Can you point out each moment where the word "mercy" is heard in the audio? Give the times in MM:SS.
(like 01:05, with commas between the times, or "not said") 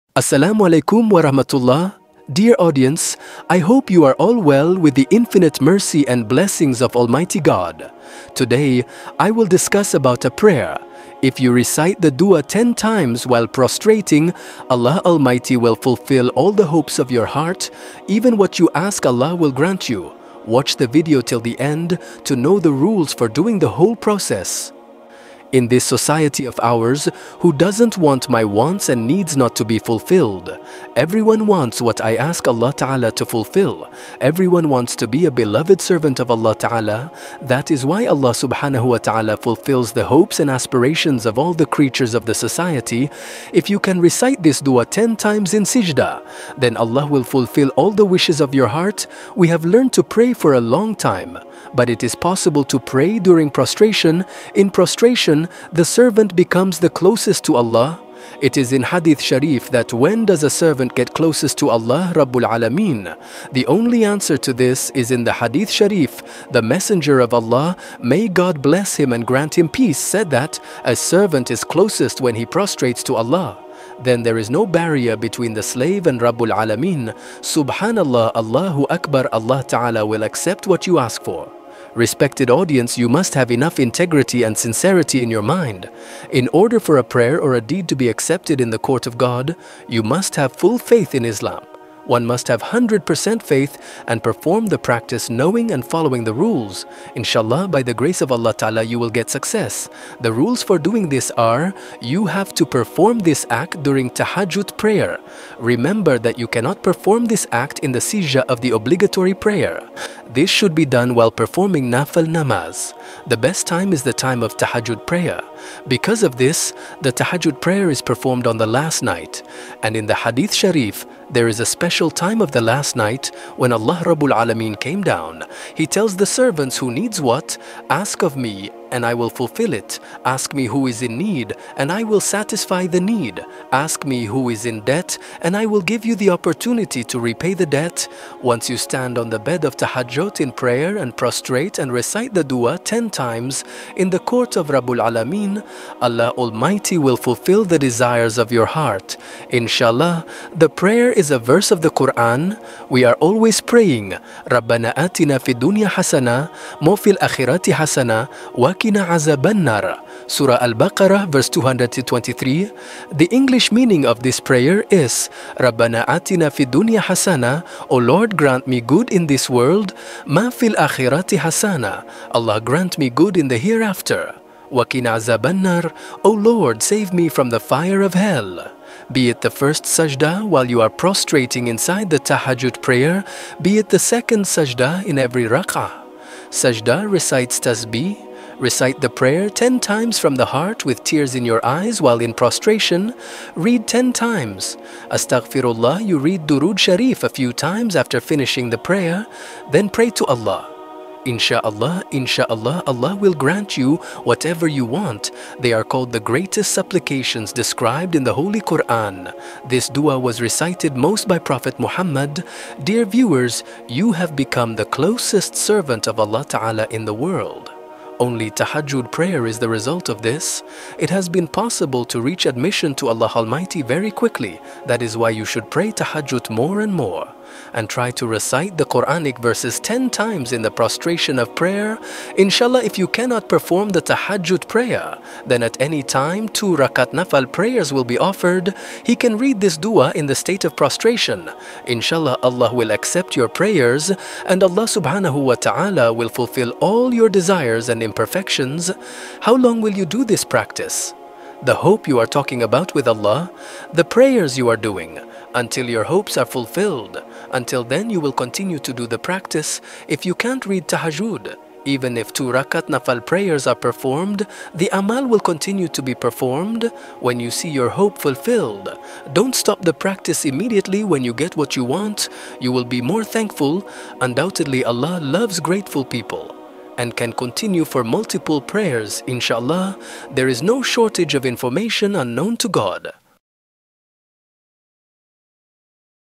00:05.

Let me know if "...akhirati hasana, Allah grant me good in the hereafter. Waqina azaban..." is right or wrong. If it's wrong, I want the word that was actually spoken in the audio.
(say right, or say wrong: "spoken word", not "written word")
right.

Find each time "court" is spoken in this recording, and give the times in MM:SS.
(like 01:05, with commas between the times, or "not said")
01:28, 02:24.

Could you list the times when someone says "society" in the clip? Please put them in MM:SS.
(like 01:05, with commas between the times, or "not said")
00:25, 00:42.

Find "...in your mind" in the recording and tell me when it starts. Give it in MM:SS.
01:25.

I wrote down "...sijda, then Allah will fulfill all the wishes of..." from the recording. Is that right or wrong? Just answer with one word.
right.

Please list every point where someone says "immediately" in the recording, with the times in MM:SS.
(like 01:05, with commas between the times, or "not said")
04:30.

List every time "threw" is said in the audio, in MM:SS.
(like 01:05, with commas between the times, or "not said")
not said.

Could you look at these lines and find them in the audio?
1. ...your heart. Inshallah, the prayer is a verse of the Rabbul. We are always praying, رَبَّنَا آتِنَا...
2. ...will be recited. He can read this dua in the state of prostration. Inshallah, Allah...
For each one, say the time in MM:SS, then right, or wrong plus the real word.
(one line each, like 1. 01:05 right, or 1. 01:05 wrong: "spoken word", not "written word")
1. 02:28 wrong: "Quran", not "Rabbul"
2. 03:57 wrong: "offered", not "recited".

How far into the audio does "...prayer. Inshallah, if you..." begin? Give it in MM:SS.
03:51.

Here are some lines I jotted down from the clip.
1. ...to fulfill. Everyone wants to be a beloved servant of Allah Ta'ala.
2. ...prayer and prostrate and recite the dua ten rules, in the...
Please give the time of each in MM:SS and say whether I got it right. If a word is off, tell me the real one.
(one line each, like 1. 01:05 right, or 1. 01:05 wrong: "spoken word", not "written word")
1. 00:33 right
2. 02:20 wrong: "times", not "rules".